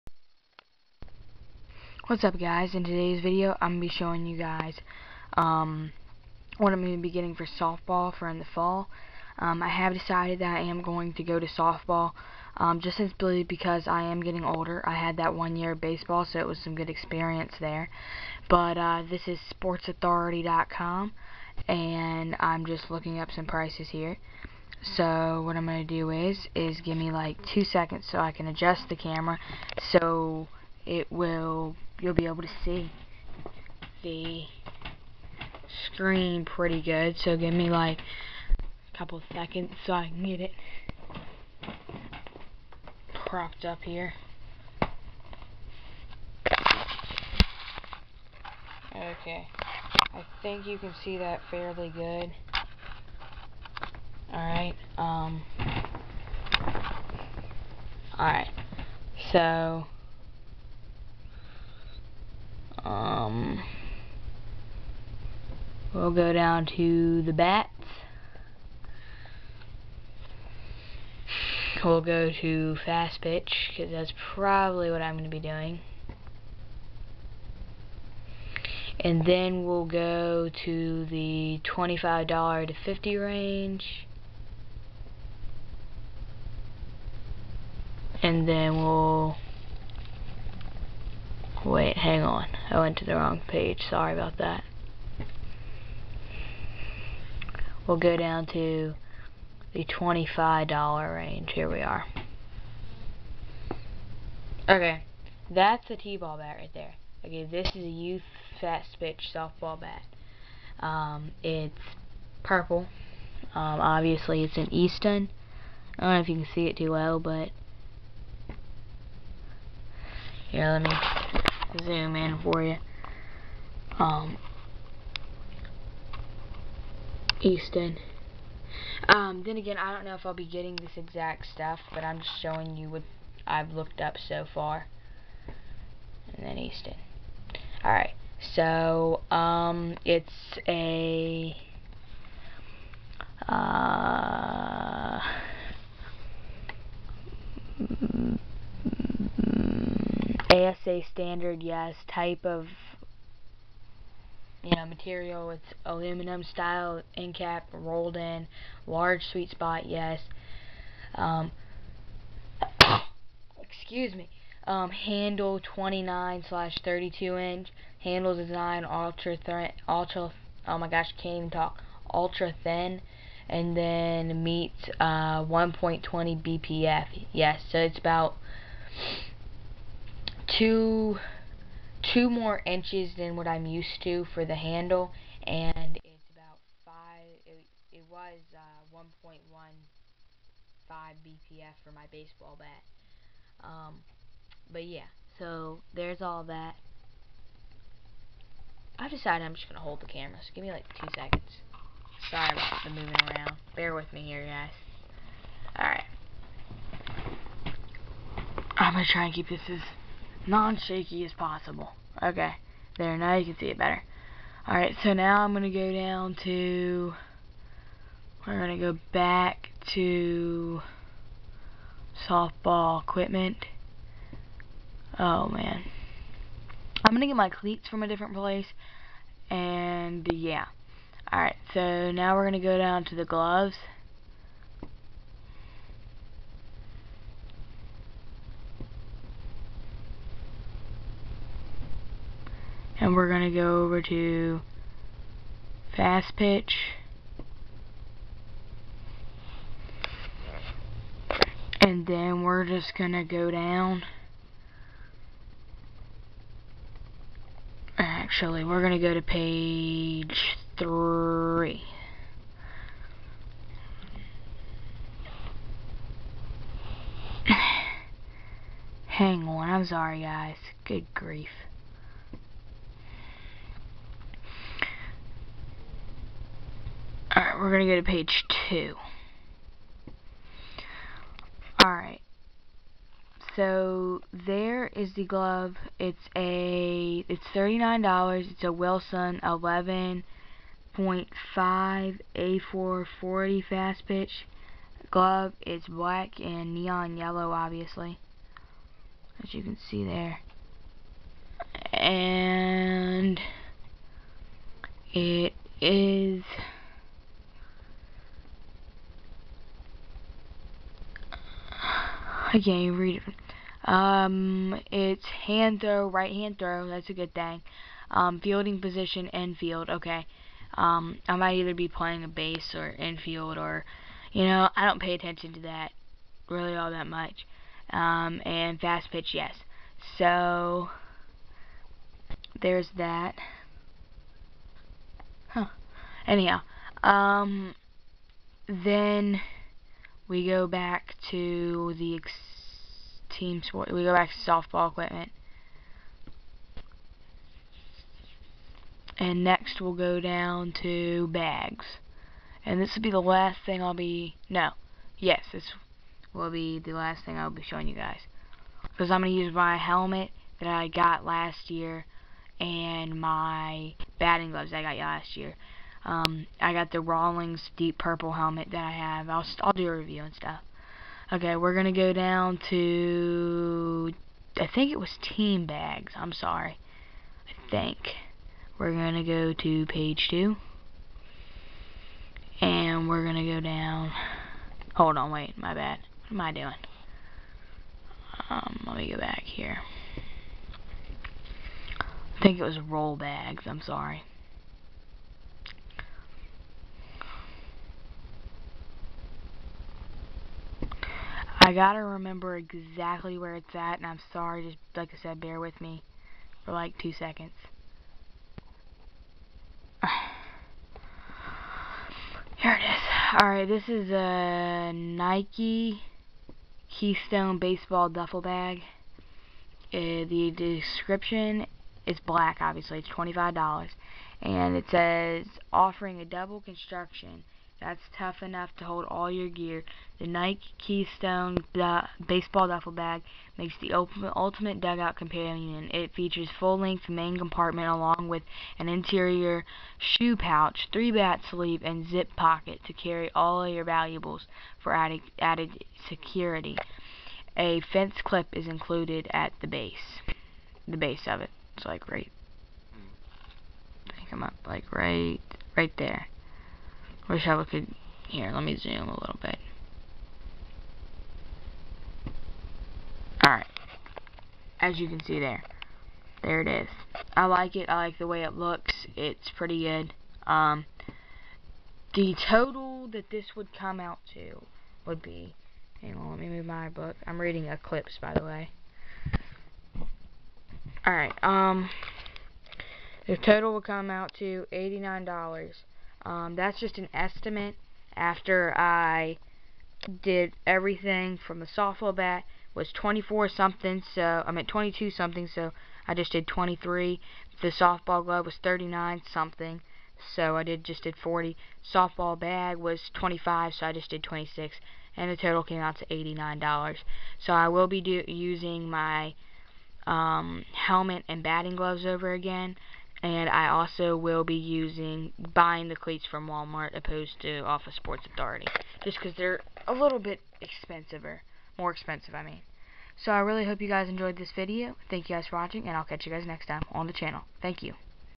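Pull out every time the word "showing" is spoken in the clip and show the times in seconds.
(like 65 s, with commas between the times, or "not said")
3 s, 132 s, 357 s.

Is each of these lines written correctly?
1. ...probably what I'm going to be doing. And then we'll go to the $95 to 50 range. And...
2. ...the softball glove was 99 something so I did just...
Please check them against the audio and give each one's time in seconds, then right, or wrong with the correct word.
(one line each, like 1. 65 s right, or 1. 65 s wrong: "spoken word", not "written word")
1. 74 s wrong: "25", not "95"
2. 497 s wrong: "39", not "99".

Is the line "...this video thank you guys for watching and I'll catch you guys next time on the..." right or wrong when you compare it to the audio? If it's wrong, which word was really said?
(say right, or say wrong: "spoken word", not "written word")
right.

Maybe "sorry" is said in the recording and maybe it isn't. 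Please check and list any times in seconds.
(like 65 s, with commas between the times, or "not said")
93 s, 202 s, 269 s, 376 s, 393 s, 404 s.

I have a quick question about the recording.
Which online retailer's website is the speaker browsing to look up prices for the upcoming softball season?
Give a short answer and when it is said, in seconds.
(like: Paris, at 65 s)
sportsauthority.com, at 19 s.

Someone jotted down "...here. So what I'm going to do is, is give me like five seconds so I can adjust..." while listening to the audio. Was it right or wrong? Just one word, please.
wrong.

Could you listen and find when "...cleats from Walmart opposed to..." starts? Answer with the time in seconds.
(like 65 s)
515 s.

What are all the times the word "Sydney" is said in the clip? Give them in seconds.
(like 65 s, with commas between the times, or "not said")
not said.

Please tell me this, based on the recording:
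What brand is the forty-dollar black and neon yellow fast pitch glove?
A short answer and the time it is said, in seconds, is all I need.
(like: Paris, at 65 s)
Wilson, at 288 s.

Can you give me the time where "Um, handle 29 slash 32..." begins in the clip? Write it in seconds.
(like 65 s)
164 s.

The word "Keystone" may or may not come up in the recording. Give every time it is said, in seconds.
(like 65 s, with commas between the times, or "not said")
416 s, 430 s.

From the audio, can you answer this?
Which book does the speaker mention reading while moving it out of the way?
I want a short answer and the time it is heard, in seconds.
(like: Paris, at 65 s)
Eclipse, at 477 s.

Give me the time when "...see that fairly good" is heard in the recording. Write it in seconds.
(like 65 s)
51 s.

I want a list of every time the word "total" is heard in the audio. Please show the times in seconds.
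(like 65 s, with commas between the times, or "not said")
472 s, 483 s, 505 s.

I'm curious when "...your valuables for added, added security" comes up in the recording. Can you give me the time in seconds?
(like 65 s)
443 s.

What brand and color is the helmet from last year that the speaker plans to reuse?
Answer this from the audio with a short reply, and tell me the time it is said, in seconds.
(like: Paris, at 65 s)
Rawlings deep purple, at 367 s.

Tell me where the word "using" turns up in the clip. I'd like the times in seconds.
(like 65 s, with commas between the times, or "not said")
508 s, 514 s.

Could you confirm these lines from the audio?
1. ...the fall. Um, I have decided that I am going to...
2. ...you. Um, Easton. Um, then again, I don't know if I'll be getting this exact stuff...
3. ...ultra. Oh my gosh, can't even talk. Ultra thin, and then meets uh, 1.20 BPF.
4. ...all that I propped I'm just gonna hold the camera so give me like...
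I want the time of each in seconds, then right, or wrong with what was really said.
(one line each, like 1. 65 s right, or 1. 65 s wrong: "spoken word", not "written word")
1. 8 s right
2. 122 s right
3. 169 s right
4. 196 s wrong: "decided", not "propped".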